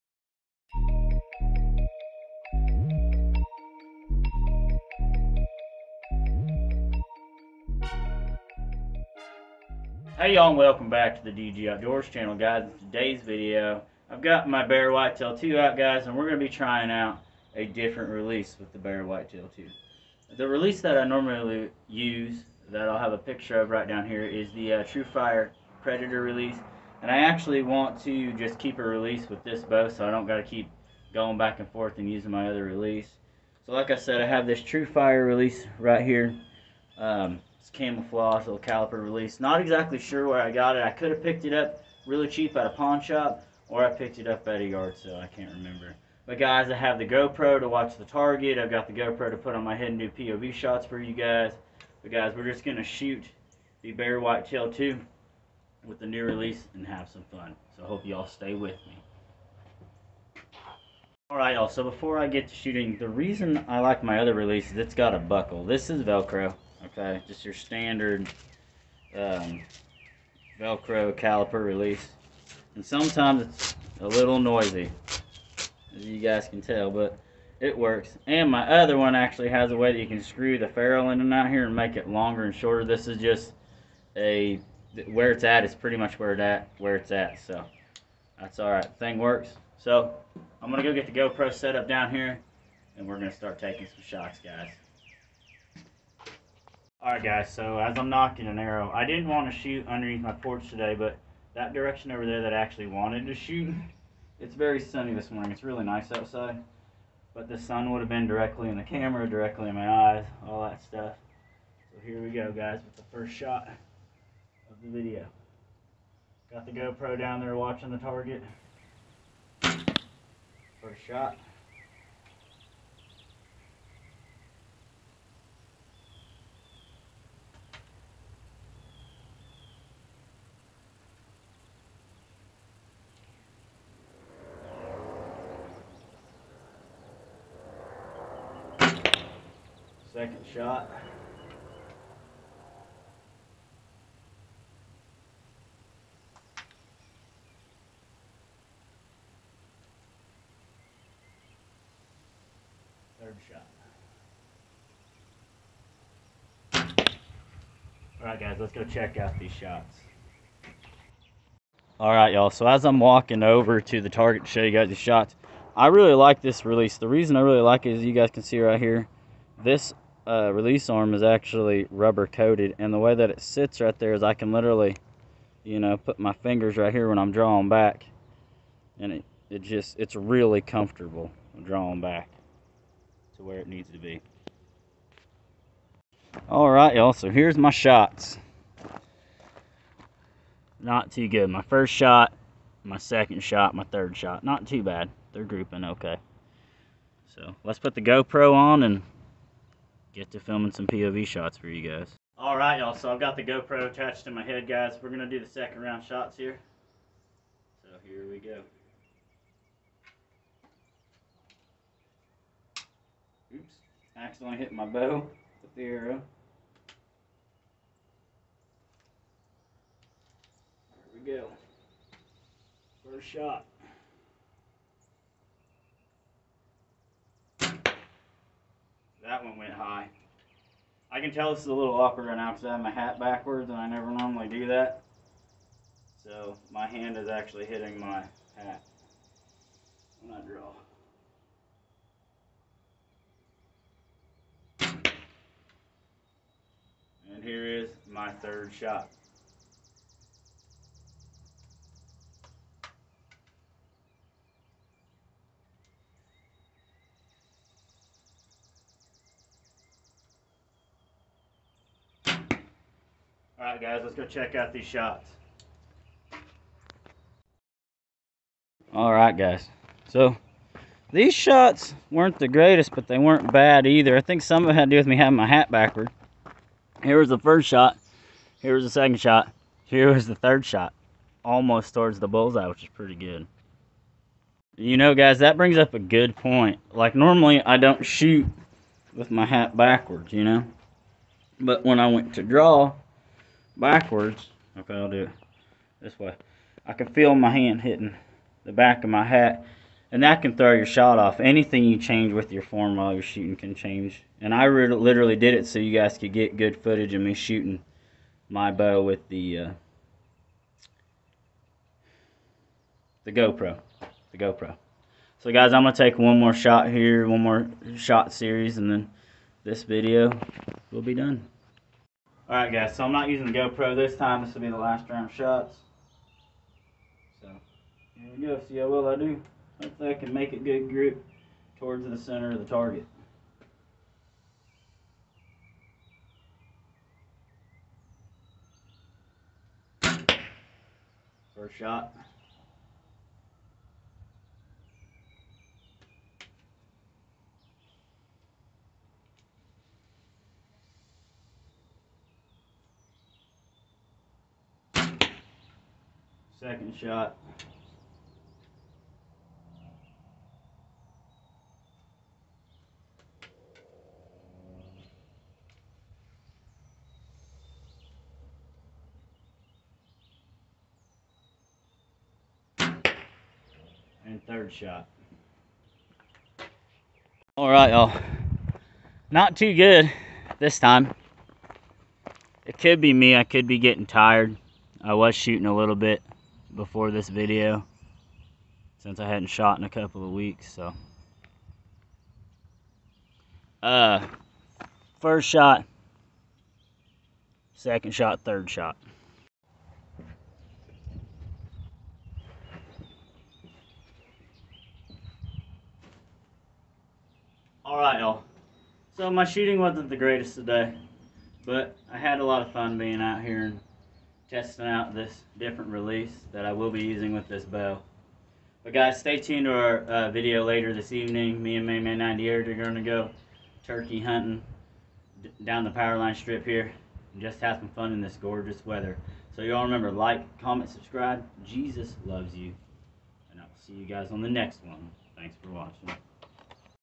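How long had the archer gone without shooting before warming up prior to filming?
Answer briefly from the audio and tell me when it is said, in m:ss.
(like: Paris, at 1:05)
A couple of weeks, at 6:29.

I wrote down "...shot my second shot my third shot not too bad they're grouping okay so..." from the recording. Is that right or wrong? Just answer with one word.
right.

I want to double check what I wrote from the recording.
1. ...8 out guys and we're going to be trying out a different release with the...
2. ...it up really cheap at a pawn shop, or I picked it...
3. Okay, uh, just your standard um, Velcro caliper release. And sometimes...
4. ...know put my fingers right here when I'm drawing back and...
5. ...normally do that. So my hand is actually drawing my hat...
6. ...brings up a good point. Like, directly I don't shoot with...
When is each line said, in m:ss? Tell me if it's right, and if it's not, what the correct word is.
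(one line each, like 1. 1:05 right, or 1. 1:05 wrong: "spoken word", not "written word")
1. 0:15 wrong: "2", not "8"
2. 0:41 right
3. 1:06 right
4. 2:55 right
5. 3:54 wrong: "hitting", not "drawing"
6. 4:45 wrong: "normally", not "directly".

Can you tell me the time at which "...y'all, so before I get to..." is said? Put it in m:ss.
1:01.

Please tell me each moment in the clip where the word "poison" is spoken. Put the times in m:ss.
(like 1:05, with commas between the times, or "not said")
not said.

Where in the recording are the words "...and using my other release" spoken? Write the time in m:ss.
0:31.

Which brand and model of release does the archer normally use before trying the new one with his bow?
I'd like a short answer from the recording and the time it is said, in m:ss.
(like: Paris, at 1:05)
TruFire Predator, at 0:24.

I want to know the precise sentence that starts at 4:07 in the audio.
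And here is my third shot.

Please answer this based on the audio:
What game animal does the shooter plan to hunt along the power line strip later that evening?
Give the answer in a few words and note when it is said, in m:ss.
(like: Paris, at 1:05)
Turkey, at 7:03.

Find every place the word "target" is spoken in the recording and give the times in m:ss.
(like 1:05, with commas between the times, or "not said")
0:48, 1:57, 2:44, 5:32.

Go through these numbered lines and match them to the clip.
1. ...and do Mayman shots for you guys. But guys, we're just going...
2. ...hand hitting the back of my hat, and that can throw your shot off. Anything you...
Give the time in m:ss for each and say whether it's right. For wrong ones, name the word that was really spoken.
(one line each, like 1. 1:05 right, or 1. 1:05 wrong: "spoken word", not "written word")
1. 0:49 wrong: "POV", not "Mayman"
2. 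4:57 right.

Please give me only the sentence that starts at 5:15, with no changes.
So guys, I'm gonna take one more shot here, one more shot series, and then this video will be done.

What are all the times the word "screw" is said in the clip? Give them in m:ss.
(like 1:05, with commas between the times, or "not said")
1:20.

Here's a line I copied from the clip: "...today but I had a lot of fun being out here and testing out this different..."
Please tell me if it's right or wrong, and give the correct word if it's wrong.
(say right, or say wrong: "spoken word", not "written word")
right.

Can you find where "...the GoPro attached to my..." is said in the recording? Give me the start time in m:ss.
3:23.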